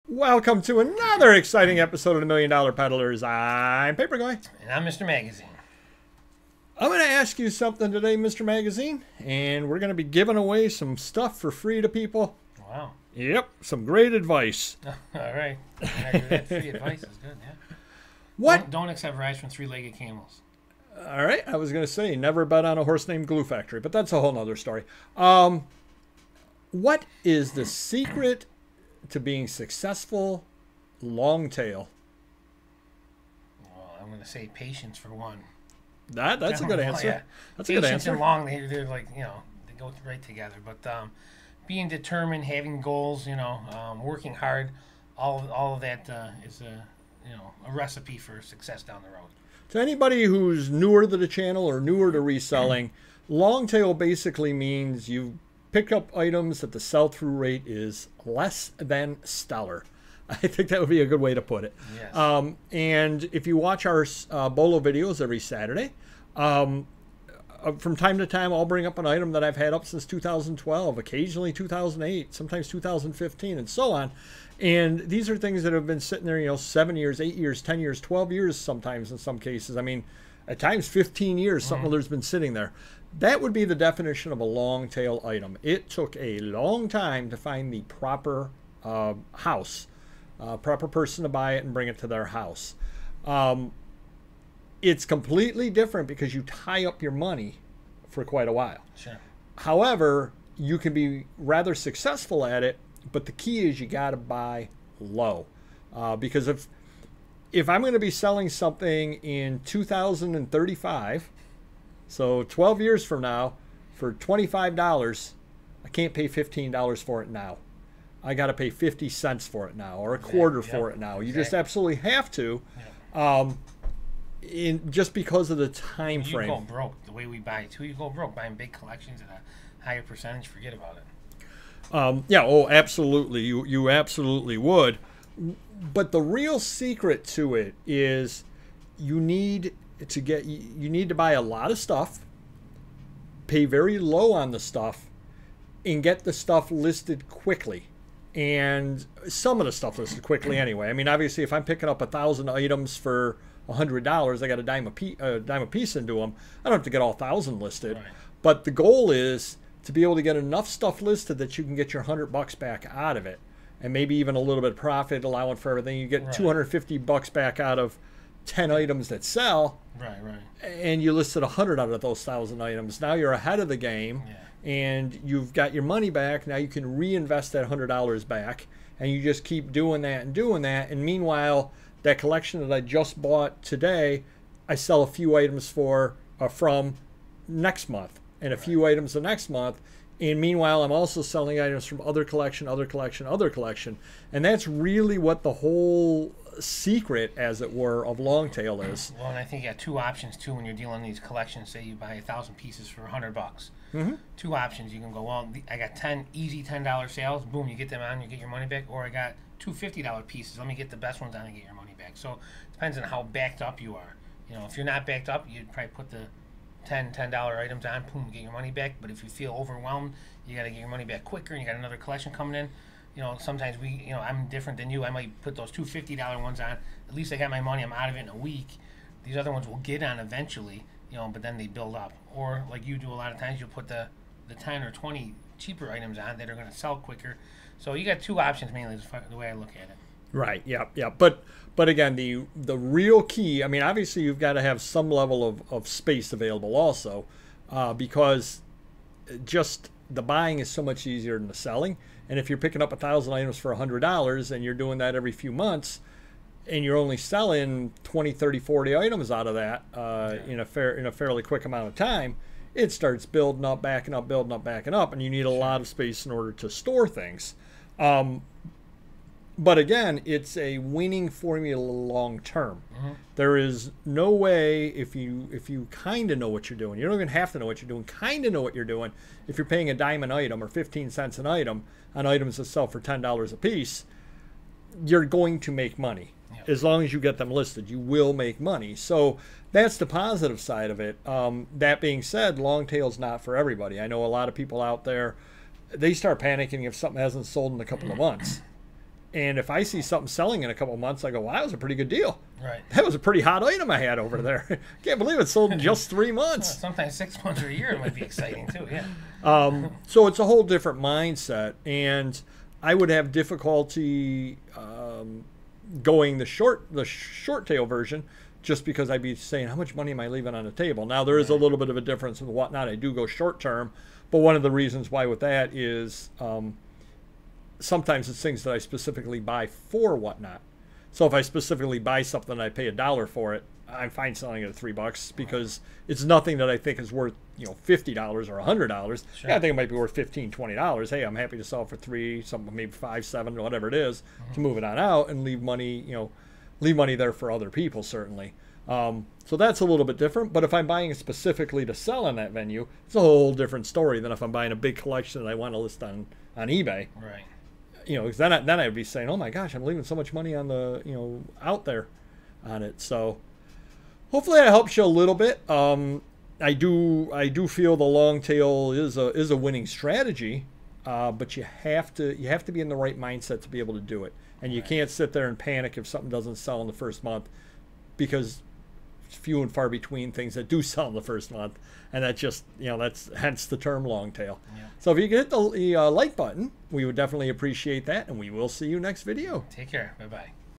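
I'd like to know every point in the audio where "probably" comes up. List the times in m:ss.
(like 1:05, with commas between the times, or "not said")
3:35.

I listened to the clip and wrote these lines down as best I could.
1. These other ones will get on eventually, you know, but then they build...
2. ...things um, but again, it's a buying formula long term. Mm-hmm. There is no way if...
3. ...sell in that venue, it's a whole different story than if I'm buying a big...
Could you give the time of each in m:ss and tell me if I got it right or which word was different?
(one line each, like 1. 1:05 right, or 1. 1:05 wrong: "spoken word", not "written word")
1. 3:49 right
2. 4:27 wrong: "winning", not "buying"
3. 5:51 right.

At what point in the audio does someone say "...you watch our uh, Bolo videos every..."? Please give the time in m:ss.
1:03.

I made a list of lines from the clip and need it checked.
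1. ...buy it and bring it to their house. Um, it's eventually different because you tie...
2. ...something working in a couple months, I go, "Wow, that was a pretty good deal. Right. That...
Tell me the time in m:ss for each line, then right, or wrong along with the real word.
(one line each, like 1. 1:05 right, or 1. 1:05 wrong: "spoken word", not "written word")
1. 1:31 wrong: "completely", not "eventually"
2. 5:00 wrong: "selling", not "working".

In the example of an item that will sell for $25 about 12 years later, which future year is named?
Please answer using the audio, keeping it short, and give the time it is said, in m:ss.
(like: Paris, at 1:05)
2035, at 1:49.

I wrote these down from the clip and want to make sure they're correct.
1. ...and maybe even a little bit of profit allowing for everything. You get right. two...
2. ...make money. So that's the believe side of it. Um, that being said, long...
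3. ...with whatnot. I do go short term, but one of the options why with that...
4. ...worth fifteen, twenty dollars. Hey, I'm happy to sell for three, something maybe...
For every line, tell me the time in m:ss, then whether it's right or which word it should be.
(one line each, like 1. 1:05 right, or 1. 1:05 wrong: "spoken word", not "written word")
1. 2:43 right
2. 4:48 wrong: "positive", not "believe"
3. 5:22 wrong: "reasons", not "options"
4. 5:39 right.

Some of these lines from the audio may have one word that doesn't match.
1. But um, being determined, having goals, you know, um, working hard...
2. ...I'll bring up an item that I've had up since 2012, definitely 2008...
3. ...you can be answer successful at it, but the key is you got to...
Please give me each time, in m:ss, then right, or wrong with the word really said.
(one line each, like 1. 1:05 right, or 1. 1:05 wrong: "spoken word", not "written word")
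1. 0:40 right
2. 1:08 wrong: "occasionally", not "definitely"
3. 1:40 wrong: "rather", not "answer".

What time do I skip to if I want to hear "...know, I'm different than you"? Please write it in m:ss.
3:44.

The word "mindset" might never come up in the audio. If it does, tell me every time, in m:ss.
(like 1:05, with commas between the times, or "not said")
5:10, 6:13.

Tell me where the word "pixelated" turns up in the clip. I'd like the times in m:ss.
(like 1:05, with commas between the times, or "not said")
not said.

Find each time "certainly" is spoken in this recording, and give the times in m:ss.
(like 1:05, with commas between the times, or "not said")
5:48.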